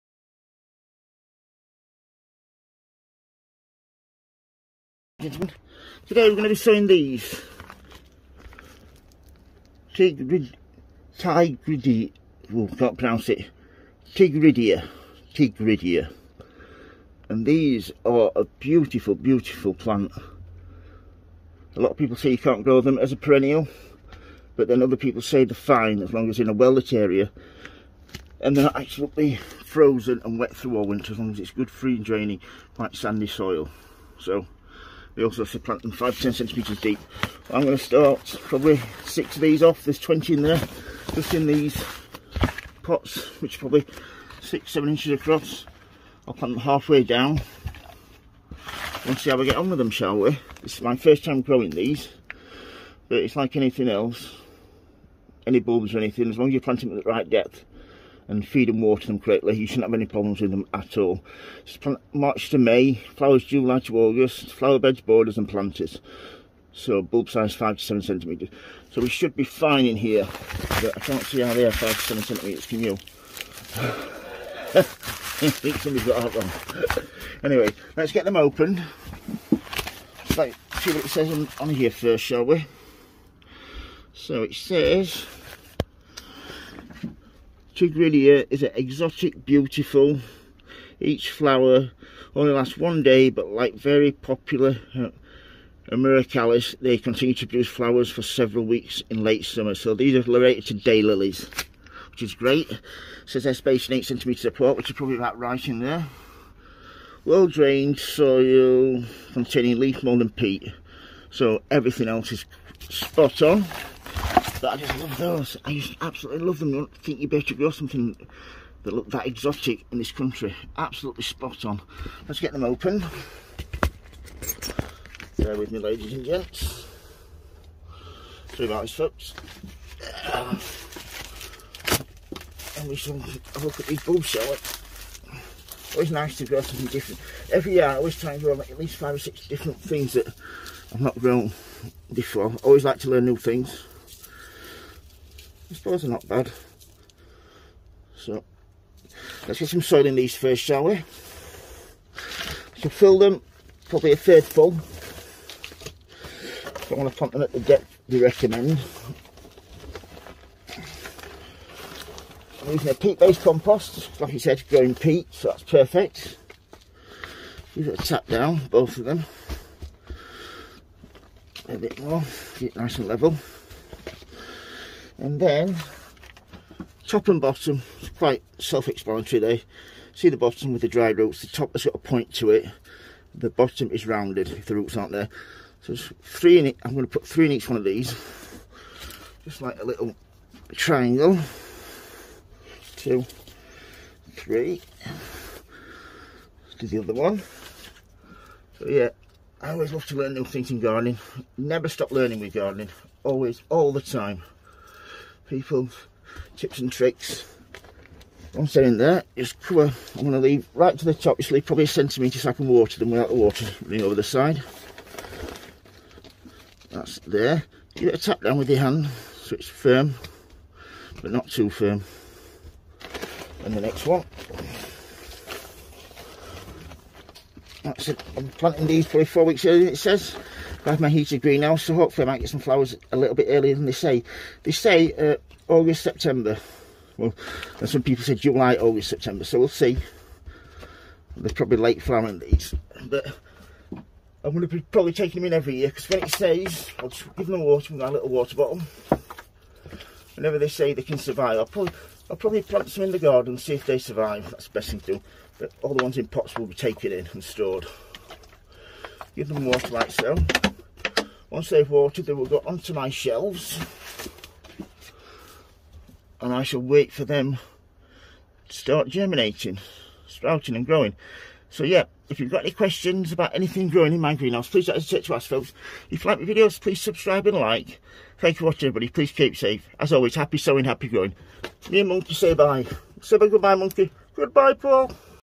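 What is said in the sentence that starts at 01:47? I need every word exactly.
Well-drained soil containing leaf mould and peat.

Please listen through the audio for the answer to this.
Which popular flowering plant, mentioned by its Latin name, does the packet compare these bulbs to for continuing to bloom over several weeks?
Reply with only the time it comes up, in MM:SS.
01:35.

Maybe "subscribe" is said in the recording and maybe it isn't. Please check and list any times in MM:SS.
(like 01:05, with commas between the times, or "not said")
04:36.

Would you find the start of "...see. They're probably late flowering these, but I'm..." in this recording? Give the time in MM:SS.
03:59.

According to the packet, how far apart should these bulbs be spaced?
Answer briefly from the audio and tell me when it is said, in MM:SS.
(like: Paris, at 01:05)
8 centimetres, at 01:43.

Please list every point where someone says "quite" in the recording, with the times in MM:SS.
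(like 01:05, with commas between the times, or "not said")
00:32, 02:58.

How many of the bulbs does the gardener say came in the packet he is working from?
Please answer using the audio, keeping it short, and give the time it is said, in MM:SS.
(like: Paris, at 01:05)
20, at 00:39.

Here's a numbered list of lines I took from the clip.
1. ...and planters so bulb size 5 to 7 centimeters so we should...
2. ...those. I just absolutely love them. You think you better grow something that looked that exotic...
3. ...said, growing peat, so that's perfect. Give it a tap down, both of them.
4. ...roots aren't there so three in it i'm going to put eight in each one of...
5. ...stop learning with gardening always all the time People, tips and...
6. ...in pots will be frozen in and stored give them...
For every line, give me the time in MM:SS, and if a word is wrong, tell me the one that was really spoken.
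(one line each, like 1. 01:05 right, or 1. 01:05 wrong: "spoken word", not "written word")
1. 01:05 right
2. 01:55 right
3. 02:44 right
4. 03:04 wrong: "three", not "eight"
5. 03:21 right
6. 04:16 wrong: "taken", not "frozen".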